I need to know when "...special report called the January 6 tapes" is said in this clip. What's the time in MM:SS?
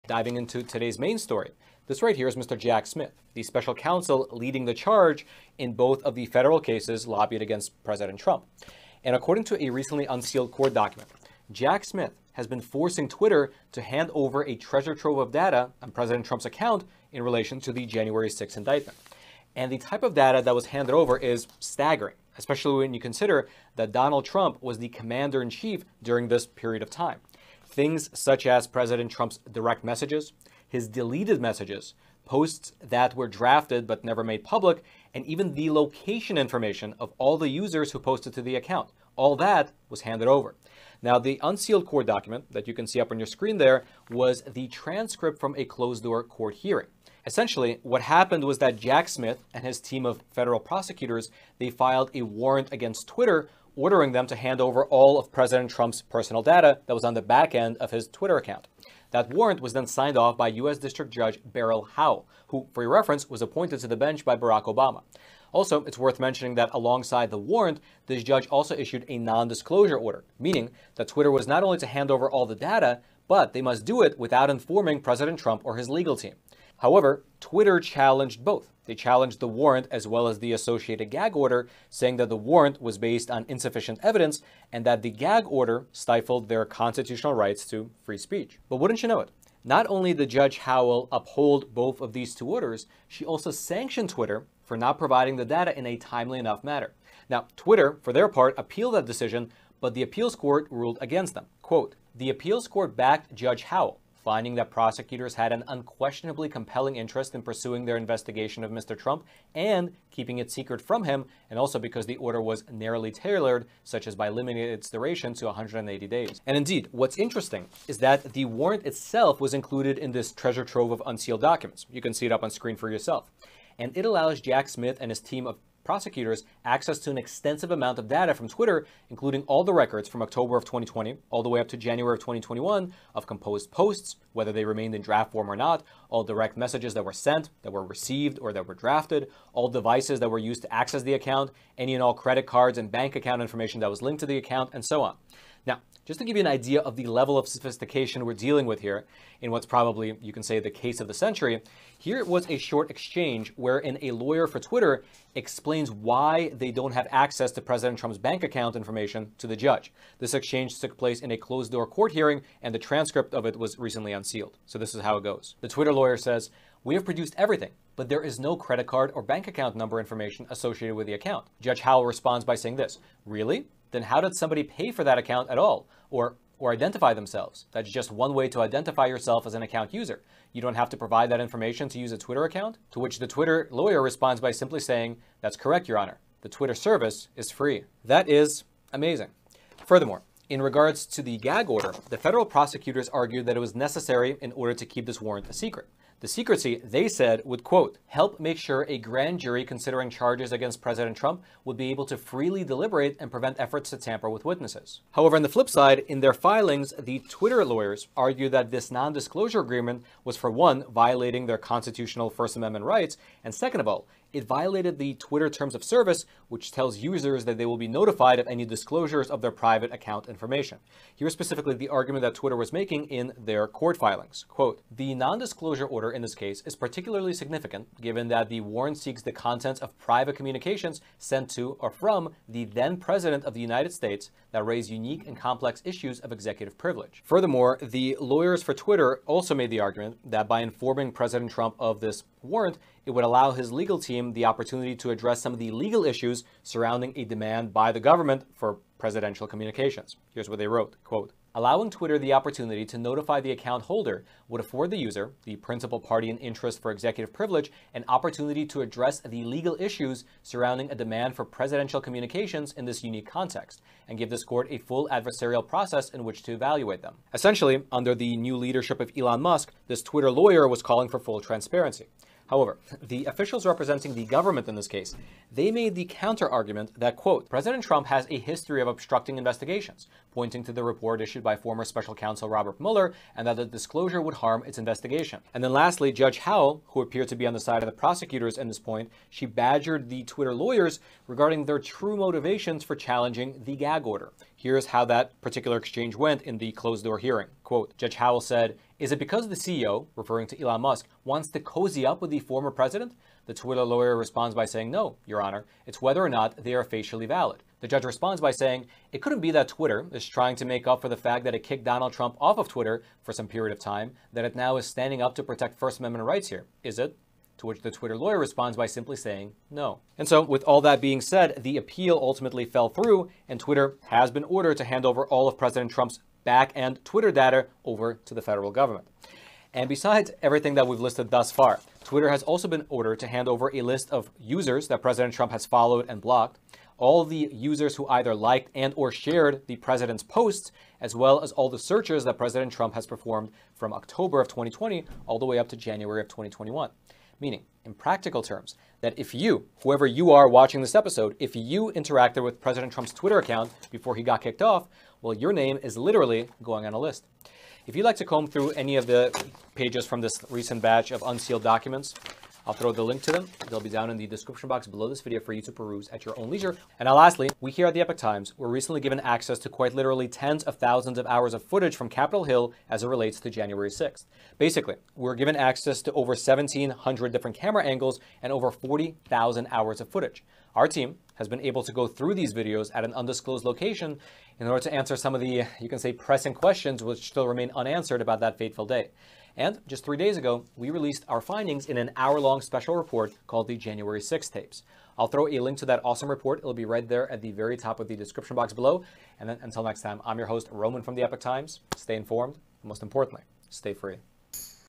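06:32.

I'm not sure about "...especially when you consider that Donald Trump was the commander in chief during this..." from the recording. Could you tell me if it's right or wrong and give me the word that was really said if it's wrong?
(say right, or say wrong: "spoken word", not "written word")
right.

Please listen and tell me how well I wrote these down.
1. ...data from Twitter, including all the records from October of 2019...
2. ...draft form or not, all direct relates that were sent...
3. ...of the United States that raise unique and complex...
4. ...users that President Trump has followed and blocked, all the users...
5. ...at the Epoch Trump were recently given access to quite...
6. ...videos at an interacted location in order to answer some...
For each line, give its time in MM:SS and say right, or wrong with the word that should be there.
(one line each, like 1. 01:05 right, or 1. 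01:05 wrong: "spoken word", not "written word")
1. 02:08 wrong: "2020", not "2019"
2. 02:15 wrong: "messages", not "relates"
3. 03:53 right
4. 05:34 right
5. 06:07 wrong: "Times", not "Trump"
6. 06:22 wrong: "undisclosed", not "interacted".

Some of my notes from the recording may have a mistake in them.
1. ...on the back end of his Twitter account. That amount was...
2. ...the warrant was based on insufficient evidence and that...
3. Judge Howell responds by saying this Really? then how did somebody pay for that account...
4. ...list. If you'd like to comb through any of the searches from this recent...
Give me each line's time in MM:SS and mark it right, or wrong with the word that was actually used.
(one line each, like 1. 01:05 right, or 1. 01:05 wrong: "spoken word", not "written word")
1. 00:57 wrong: "warrant", not "amount"
2. 01:22 right
3. 02:51 right
4. 05:56 wrong: "pages", not "searches".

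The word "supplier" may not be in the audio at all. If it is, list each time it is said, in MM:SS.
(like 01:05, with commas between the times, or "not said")
not said.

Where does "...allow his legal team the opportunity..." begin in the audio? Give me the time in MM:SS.
04:03.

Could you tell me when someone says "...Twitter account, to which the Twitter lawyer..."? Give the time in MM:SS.
03:02.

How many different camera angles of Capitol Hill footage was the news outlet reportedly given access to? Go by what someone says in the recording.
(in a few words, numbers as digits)
1,700.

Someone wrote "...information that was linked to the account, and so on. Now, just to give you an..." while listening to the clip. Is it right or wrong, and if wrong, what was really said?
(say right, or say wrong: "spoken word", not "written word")
right.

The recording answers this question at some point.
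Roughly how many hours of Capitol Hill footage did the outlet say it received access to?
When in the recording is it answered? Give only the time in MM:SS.
06:18.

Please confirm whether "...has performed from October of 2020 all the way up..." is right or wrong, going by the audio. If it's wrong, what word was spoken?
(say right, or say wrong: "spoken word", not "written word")
right.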